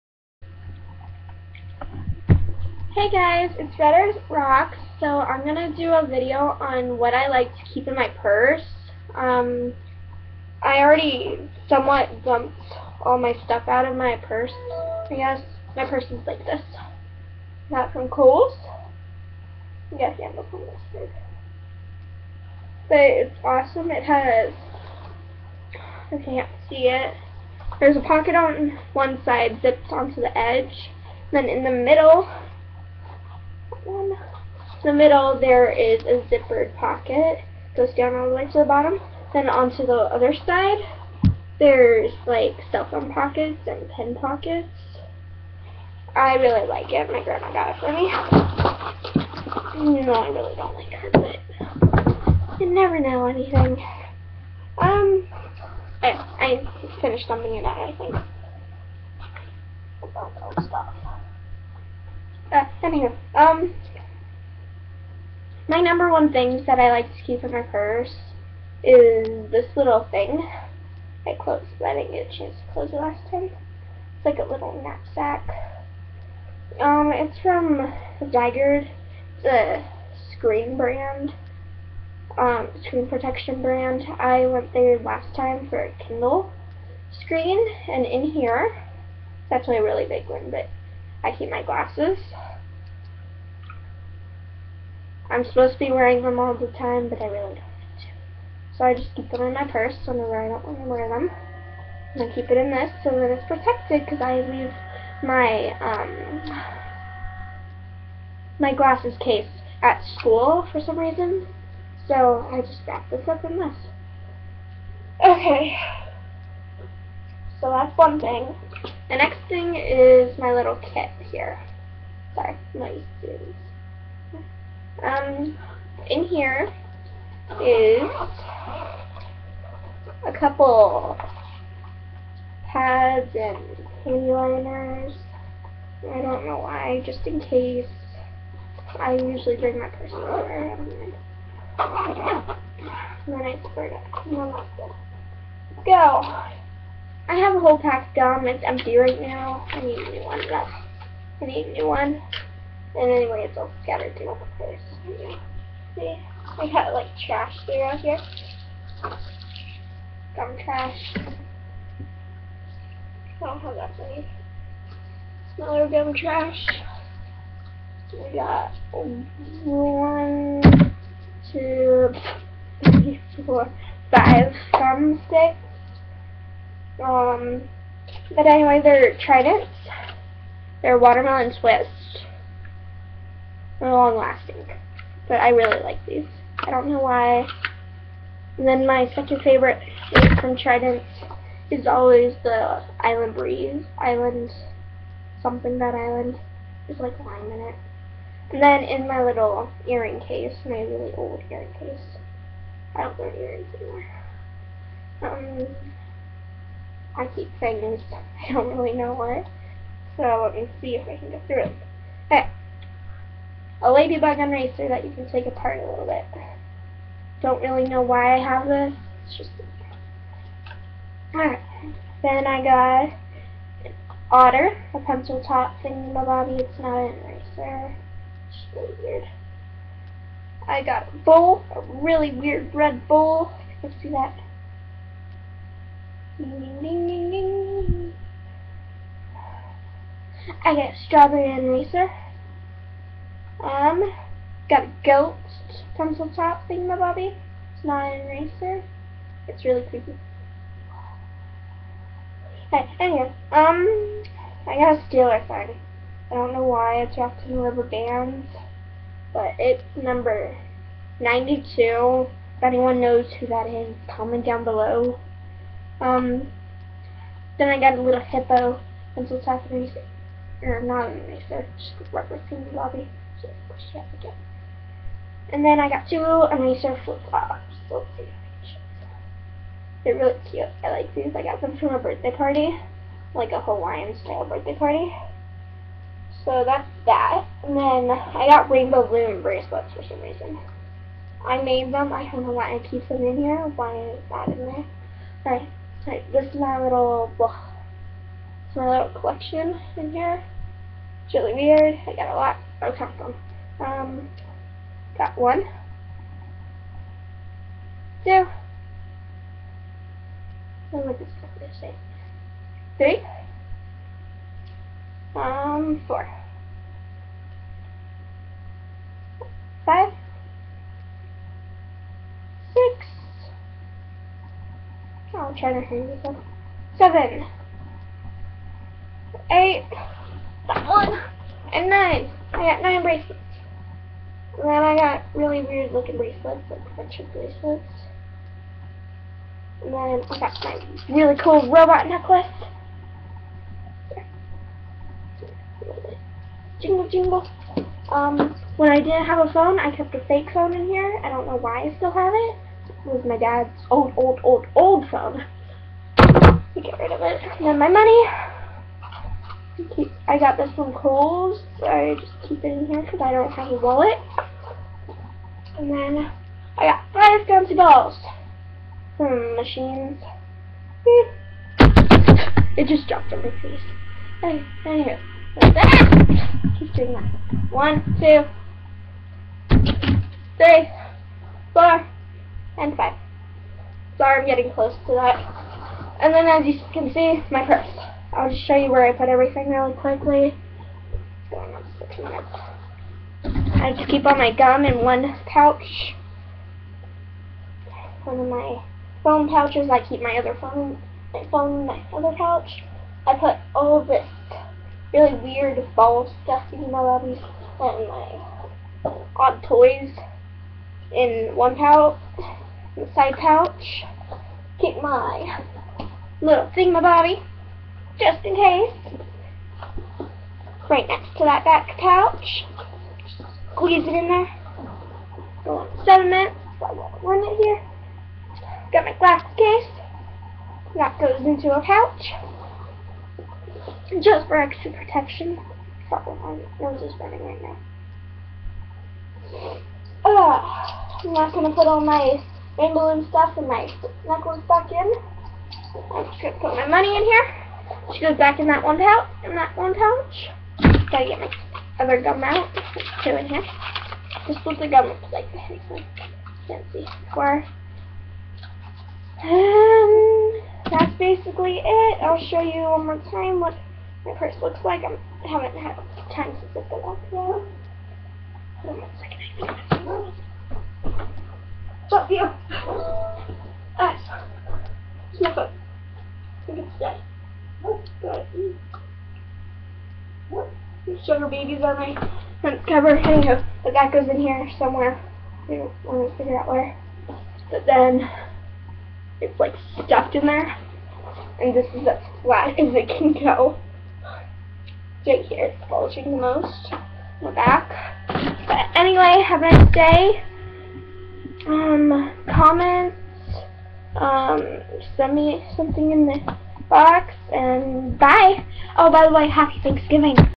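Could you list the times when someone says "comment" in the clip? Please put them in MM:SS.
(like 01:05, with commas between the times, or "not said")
04:24, 08:22.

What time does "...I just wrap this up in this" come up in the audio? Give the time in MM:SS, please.
01:52.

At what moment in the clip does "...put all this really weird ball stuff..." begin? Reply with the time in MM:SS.
06:43.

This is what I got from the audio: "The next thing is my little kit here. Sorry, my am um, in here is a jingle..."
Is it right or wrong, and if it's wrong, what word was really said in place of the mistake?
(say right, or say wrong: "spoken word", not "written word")
wrong: "couple", not "jingle".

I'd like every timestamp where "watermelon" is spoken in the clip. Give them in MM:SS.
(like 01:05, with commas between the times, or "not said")
03:00.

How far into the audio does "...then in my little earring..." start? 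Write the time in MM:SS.
03:18.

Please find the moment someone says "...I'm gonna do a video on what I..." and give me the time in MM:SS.
00:05.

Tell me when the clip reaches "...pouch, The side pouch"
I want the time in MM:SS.
06:51.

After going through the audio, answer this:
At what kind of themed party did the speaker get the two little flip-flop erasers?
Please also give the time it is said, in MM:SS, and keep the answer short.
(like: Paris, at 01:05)
Hawaiian-style birthday party, at 04:43.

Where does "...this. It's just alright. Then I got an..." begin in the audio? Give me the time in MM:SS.
03:38.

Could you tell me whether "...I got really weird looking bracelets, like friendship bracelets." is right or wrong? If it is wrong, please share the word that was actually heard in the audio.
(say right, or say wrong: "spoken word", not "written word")
right.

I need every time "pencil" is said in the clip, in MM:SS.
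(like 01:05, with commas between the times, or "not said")
03:44, 04:05, 04:29.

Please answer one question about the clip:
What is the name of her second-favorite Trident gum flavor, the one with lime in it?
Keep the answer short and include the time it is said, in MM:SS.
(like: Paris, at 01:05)
Island Breeze, at 03:12.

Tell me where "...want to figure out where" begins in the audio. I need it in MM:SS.
08:06.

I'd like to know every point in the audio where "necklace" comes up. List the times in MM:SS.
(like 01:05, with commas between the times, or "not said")
05:42, 07:24.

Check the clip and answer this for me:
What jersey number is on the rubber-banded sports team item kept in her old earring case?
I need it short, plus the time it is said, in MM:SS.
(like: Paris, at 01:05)
92, at 04:21.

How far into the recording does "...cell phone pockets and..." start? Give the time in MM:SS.
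00:42.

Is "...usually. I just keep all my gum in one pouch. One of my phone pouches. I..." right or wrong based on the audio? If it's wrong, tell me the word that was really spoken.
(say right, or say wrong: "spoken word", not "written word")
wrong: "quickly", not "usually".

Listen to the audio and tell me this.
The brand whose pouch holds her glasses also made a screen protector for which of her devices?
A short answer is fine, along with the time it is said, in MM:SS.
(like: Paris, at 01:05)
Kindle, at 01:26.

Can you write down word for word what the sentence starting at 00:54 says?
Um, I, I finished dumping it out, I think.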